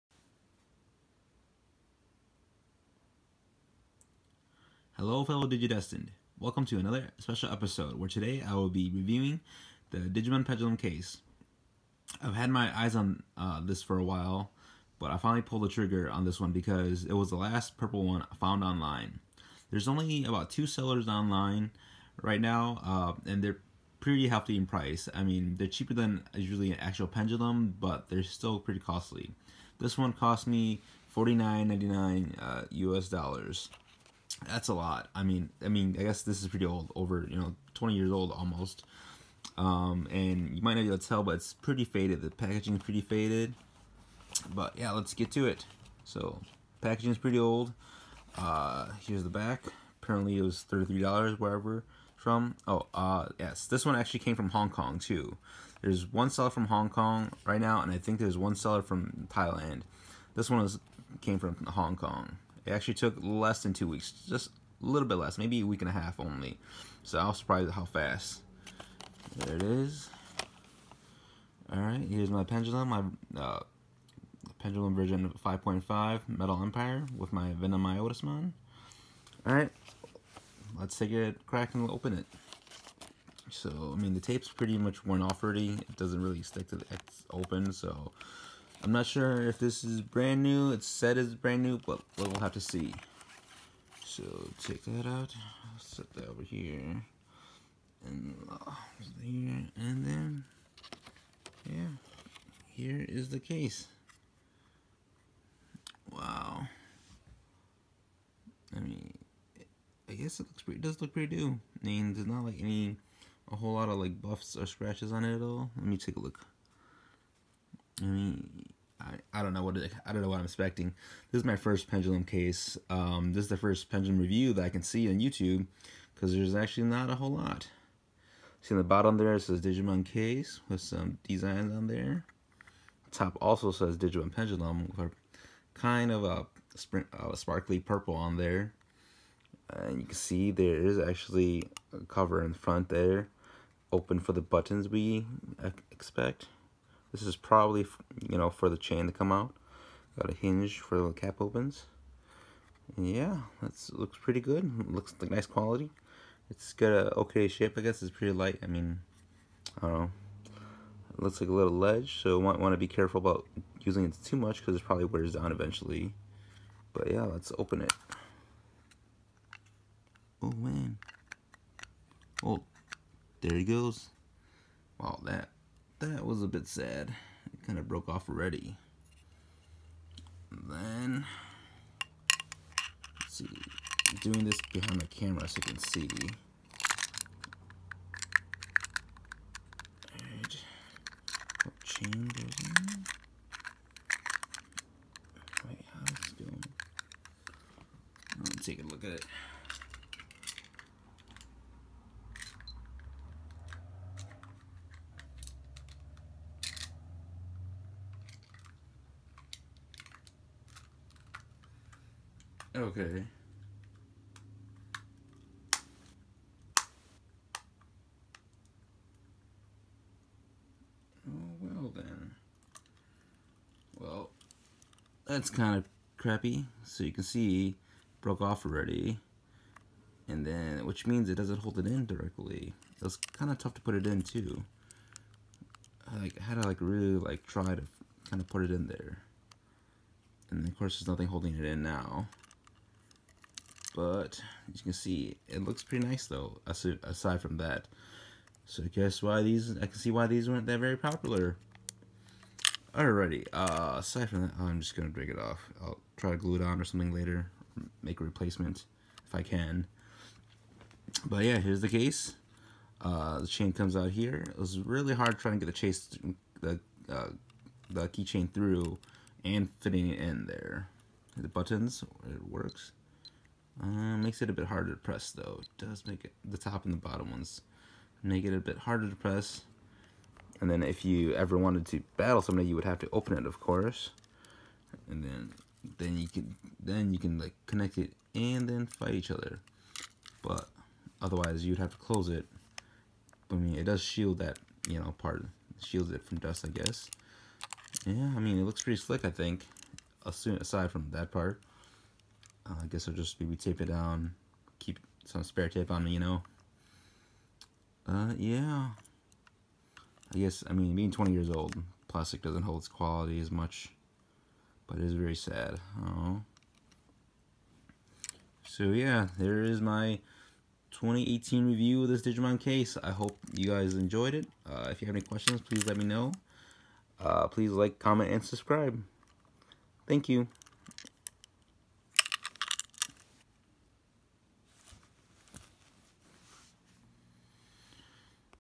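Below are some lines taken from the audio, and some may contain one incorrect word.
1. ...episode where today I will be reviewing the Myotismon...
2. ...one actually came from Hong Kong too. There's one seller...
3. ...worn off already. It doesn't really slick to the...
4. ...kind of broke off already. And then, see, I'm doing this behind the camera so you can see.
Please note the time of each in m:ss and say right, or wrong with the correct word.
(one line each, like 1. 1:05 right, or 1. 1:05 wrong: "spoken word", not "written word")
1. 0:07 wrong: "Digimon", not "Myotismon"
2. 0:53 right
3. 1:25 wrong: "stick", not "slick"
4. 2:57 right.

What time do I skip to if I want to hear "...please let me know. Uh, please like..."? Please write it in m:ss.
5:25.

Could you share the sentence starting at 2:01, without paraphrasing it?
This is my first pendulum case.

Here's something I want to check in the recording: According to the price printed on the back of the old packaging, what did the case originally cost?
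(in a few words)
$33.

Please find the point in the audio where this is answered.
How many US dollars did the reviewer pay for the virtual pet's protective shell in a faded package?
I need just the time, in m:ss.
0:31.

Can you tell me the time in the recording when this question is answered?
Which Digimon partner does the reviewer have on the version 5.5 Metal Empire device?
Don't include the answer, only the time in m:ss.
1:17.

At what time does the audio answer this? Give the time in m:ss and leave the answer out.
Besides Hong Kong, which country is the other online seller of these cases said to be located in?
0:59.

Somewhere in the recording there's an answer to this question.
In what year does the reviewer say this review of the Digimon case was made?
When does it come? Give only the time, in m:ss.
5:20.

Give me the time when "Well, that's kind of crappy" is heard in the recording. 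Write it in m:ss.
3:43.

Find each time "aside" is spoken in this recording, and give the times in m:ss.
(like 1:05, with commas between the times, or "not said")
4:06, 4:13, 5:00.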